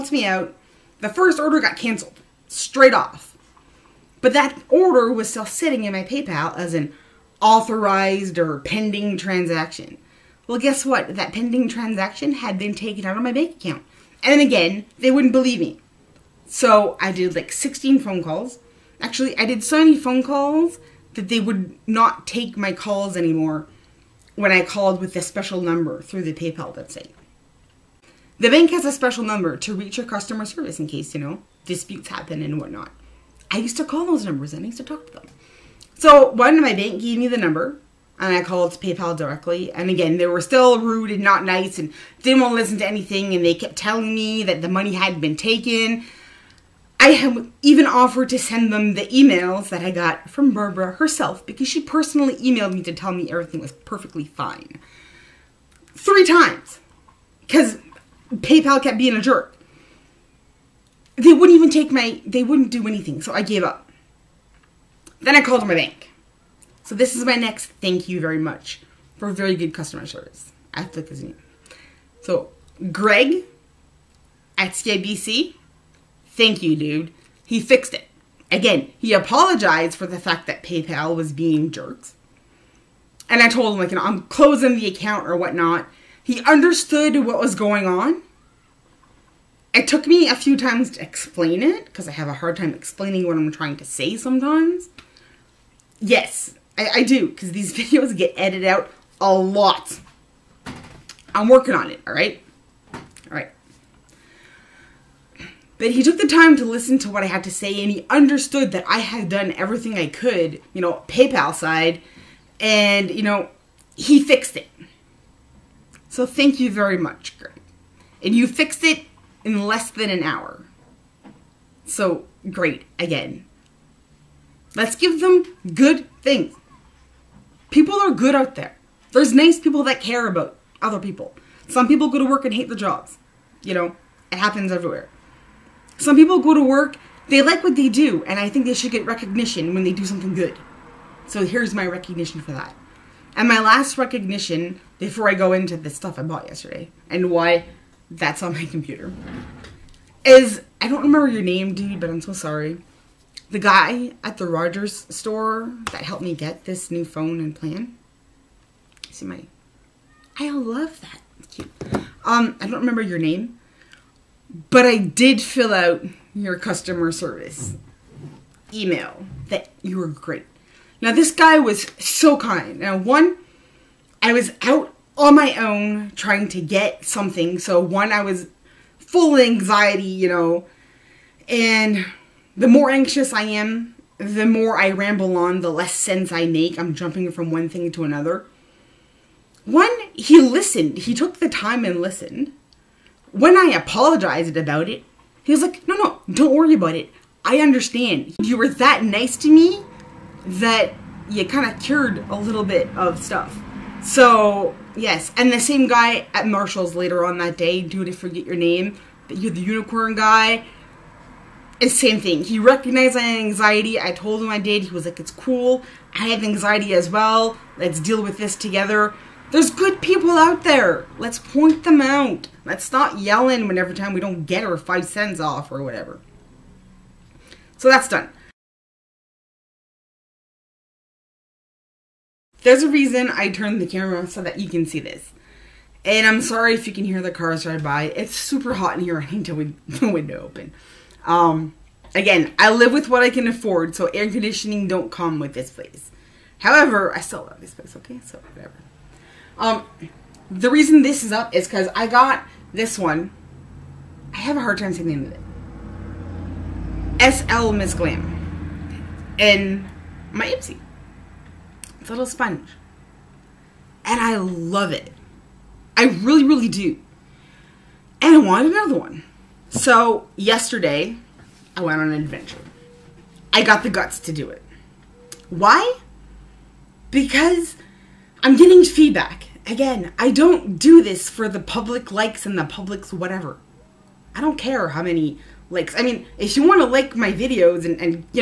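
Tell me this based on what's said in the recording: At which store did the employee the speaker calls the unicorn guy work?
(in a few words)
Marshall's.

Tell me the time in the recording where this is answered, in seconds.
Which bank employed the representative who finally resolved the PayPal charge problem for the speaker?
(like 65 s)
74 s.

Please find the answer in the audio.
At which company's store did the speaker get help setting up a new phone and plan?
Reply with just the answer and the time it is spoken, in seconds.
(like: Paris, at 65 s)
Rogers, at 154 s.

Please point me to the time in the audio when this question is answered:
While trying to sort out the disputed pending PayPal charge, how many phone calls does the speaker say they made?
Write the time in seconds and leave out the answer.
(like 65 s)
17 s.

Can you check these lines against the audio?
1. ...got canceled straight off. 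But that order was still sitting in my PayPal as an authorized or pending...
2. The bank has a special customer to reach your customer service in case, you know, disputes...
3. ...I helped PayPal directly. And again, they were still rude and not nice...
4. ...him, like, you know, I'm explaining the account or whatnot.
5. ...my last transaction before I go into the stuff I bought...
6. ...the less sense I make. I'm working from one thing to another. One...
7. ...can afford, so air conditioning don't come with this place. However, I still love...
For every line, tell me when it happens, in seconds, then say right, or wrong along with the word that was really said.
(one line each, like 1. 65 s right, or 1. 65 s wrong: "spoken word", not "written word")
1. 1 s right
2. 28 s wrong: "number", not "customer"
3. 38 s wrong: "called", not "helped"
4. 83 s wrong: "closing", not "explaining"
5. 143 s wrong: "recognition", not "transaction"
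6. 185 s wrong: "jumping", not "working"
7. 243 s right.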